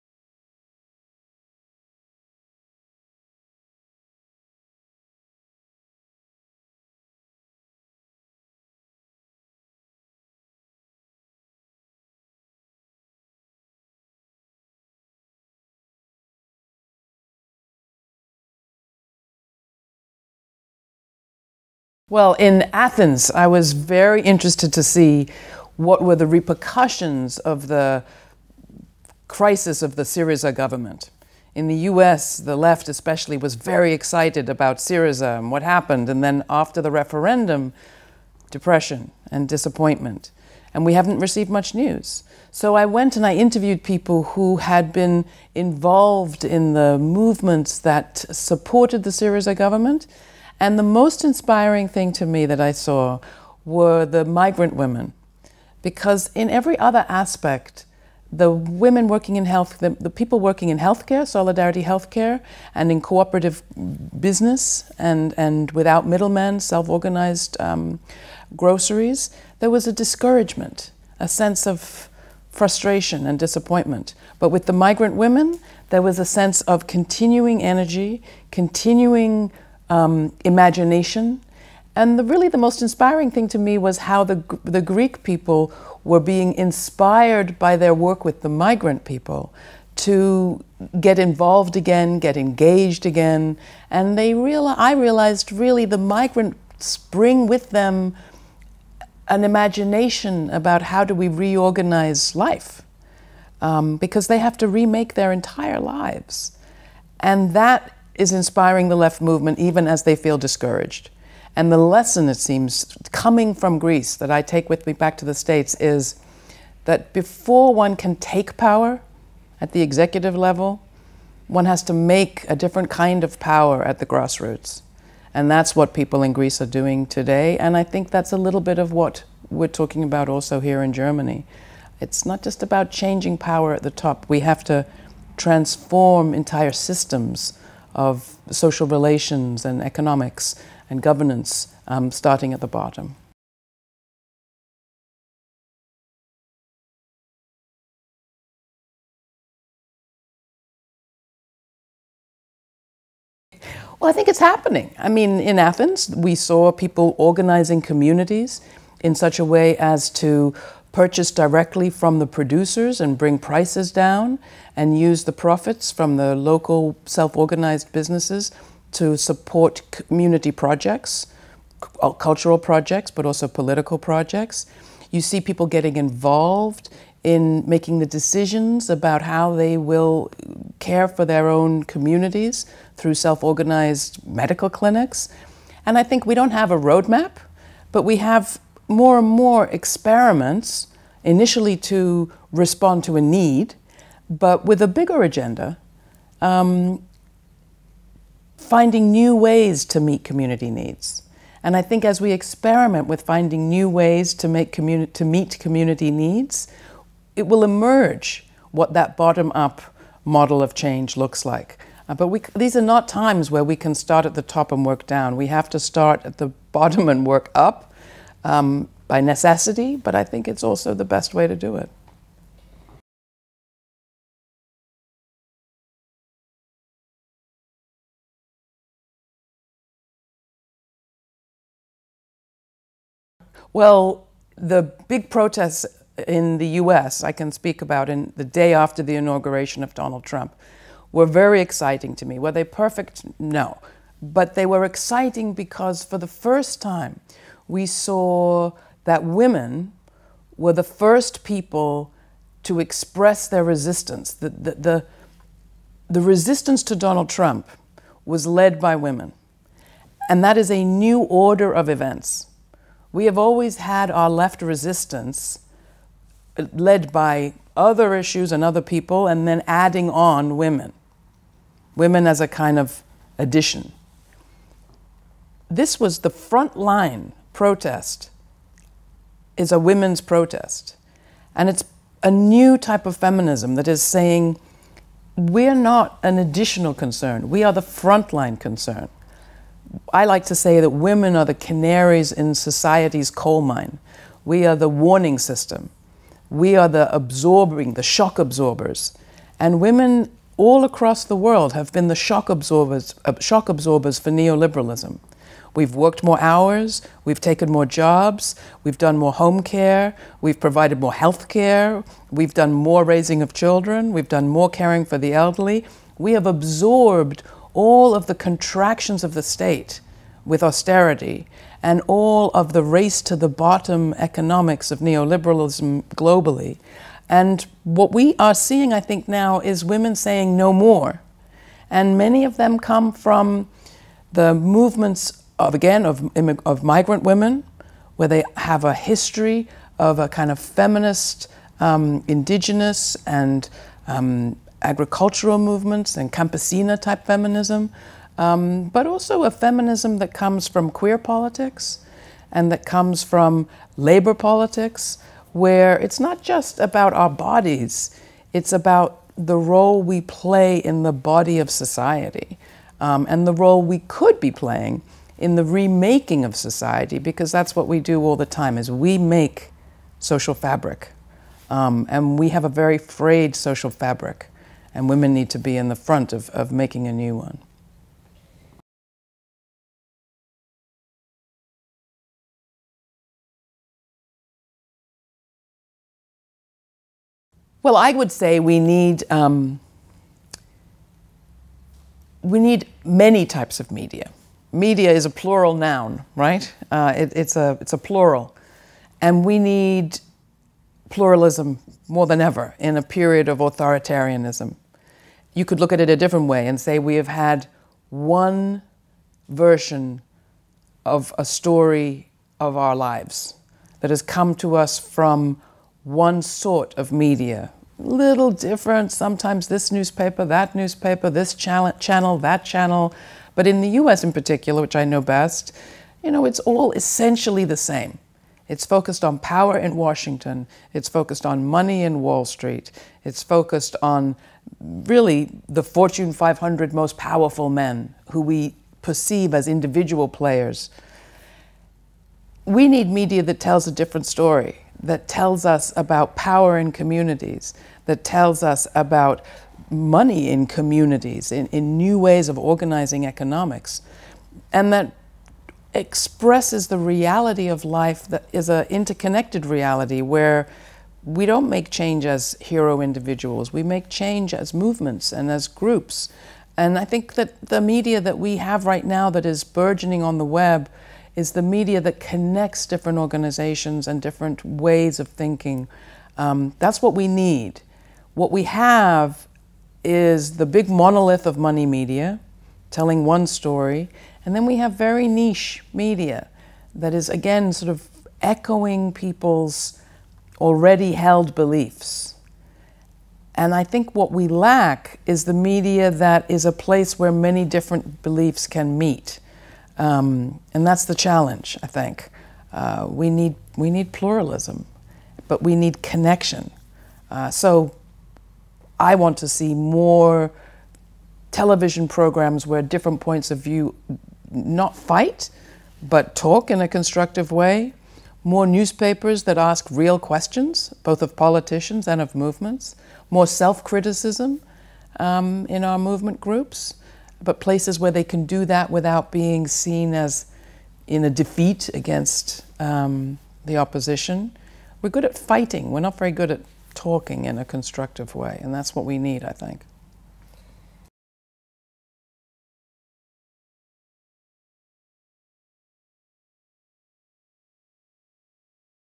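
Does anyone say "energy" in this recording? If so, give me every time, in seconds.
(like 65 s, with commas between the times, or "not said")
77 s.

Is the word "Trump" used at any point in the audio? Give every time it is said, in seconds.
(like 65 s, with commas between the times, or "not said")
240 s, 257 s.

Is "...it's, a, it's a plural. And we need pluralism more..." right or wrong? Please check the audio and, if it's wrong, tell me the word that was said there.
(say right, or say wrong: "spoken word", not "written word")
right.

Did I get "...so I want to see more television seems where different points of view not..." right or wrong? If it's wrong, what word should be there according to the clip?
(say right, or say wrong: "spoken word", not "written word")
wrong: "programs", not "seems".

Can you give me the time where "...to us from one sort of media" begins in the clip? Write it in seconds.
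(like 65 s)
414 s.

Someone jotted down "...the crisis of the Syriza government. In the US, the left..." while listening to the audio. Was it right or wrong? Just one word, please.
right.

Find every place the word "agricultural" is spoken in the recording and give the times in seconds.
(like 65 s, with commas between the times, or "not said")
344 s.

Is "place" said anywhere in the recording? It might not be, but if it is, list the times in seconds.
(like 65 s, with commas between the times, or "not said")
496 s, 527 s.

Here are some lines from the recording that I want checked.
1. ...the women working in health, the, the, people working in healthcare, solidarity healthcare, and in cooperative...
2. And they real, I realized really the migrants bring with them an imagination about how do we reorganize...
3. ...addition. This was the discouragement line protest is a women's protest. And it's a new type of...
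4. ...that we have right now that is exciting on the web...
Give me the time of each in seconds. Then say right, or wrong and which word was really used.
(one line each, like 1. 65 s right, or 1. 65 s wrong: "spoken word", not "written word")
1. 58 s right
2. 93 s right
3. 273 s wrong: "front", not "discouragement"
4. 468 s wrong: "burgeoning", not "exciting".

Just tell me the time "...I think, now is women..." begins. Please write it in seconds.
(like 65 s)
328 s.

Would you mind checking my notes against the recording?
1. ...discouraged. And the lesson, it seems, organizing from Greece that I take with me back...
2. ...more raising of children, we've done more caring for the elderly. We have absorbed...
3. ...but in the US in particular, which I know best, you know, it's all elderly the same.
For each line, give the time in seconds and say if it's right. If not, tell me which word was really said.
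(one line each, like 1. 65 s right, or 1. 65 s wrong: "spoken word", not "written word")
1. 110 s wrong: "coming", not "organizing"
2. 312 s right
3. 423 s wrong: "essentially", not "elderly".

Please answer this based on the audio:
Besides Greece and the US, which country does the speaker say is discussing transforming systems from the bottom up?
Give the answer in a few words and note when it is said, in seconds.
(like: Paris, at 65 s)
Germany, at 130 s.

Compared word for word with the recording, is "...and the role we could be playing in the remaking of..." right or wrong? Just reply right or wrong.
right.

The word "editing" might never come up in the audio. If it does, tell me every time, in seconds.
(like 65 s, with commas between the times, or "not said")
not said.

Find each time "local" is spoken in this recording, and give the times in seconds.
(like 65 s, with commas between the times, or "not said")
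166 s.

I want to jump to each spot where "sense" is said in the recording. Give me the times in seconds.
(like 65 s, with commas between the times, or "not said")
71 s, 76 s.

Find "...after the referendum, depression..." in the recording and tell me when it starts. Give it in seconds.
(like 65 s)
36 s.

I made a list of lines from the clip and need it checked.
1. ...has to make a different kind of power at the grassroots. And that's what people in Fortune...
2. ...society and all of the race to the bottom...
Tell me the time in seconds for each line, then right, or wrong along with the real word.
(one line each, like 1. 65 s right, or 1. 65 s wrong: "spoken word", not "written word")
1. 121 s wrong: "Greece", not "Fortune"
2. 320 s wrong: "austerity", not "society".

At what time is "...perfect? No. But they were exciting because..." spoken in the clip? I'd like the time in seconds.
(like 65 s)
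242 s.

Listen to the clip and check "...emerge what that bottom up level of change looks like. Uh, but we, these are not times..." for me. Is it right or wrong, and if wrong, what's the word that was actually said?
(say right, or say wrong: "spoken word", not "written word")
wrong: "model", not "level".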